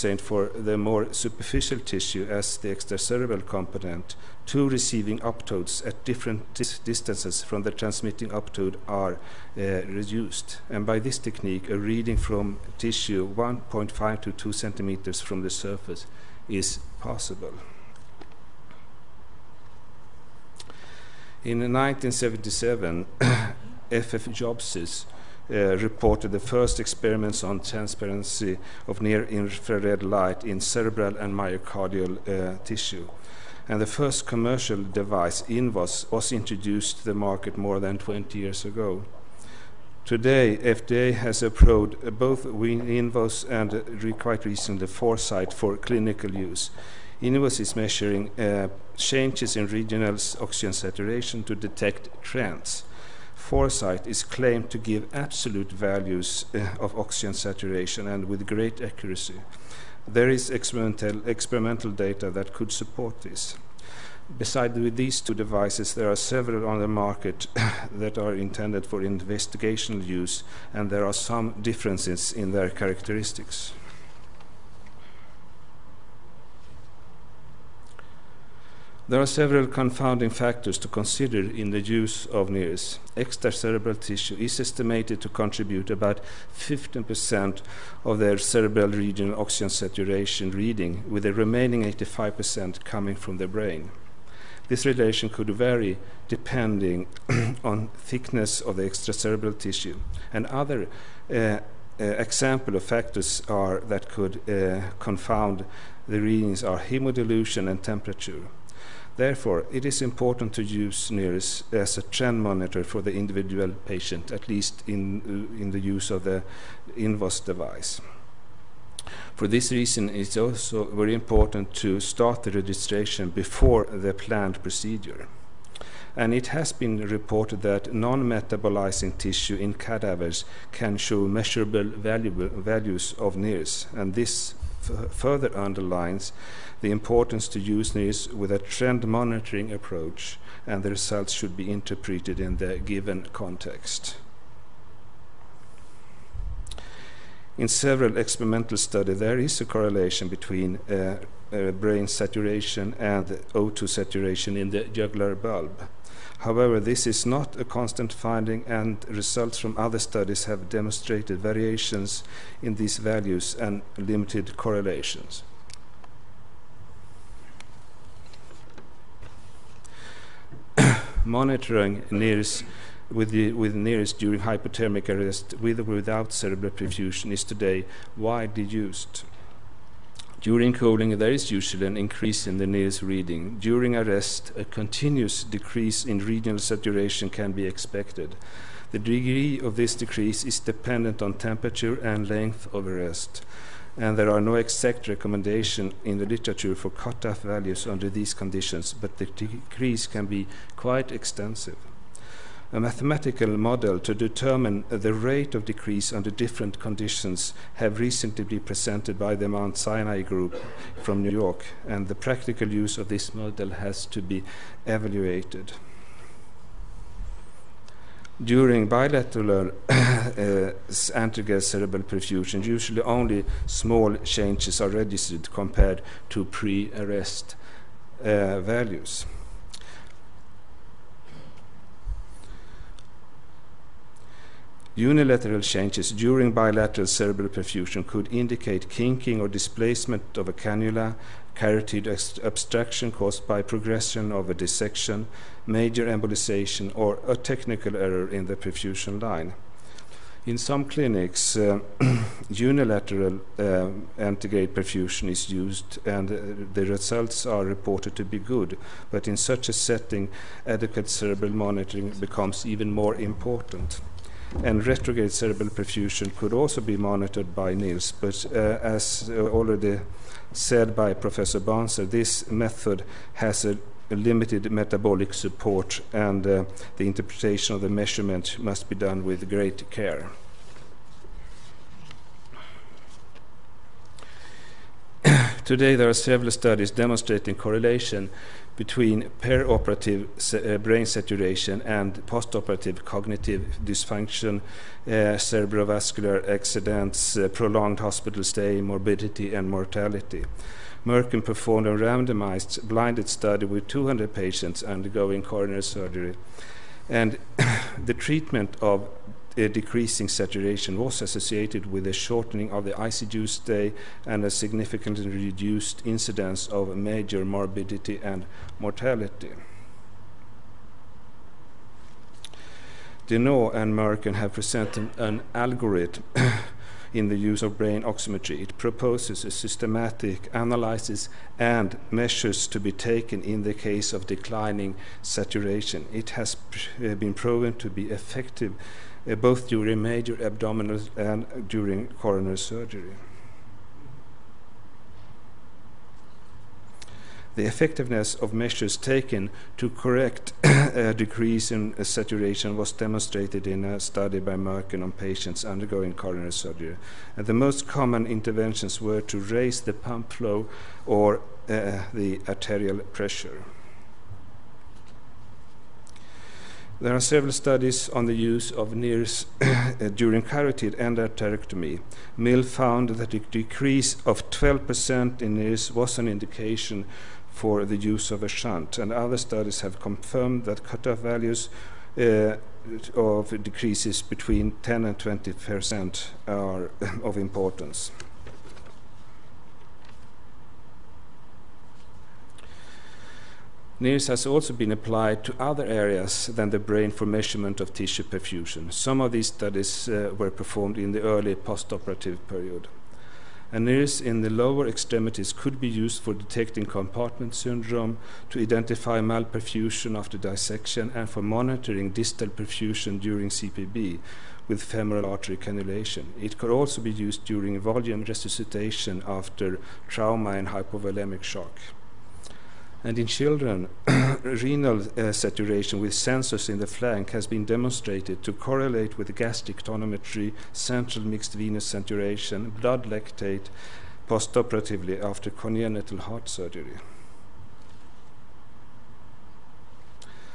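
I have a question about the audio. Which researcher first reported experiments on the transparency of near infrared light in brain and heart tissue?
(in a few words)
F.F. Jobsis.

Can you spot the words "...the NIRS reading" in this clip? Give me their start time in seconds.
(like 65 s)
182 s.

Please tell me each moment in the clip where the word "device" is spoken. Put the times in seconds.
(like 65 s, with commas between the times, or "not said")
34 s, 65 s, 117 s.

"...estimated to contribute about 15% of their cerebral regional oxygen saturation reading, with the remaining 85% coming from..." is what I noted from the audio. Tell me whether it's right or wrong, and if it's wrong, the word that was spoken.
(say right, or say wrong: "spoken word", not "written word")
right.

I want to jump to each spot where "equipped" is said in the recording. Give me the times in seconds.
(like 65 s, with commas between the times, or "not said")
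not said.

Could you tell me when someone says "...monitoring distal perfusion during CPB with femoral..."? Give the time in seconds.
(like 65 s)
411 s.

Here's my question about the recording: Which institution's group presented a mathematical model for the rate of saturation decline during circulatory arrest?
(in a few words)
Mount Sinai.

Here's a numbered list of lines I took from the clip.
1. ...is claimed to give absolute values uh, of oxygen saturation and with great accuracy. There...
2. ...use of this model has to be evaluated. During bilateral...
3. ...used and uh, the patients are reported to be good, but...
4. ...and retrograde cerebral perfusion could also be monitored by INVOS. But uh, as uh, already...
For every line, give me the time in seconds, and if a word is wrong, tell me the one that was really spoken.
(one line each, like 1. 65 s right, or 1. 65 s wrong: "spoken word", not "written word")
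1. 54 s right
2. 212 s right
3. 255 s wrong: "results", not "patients"
4. 264 s wrong: "NIRS", not "INVOS".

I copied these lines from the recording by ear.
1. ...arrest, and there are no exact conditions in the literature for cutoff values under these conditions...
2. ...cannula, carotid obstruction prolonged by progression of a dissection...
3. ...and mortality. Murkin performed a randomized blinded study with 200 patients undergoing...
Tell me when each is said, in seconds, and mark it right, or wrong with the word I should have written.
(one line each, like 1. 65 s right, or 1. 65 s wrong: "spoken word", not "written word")
1. 192 s wrong: "recommendations", not "conditions"
2. 240 s wrong: "caused", not "prolonged"
3. 299 s right.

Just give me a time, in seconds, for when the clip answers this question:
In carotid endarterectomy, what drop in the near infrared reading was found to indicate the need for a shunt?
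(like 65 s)
374 s.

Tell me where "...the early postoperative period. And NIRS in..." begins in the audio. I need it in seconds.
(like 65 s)
401 s.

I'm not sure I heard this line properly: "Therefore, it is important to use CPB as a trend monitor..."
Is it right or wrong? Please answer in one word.
wrong.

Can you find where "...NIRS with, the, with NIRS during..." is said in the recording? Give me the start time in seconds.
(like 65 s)
172 s.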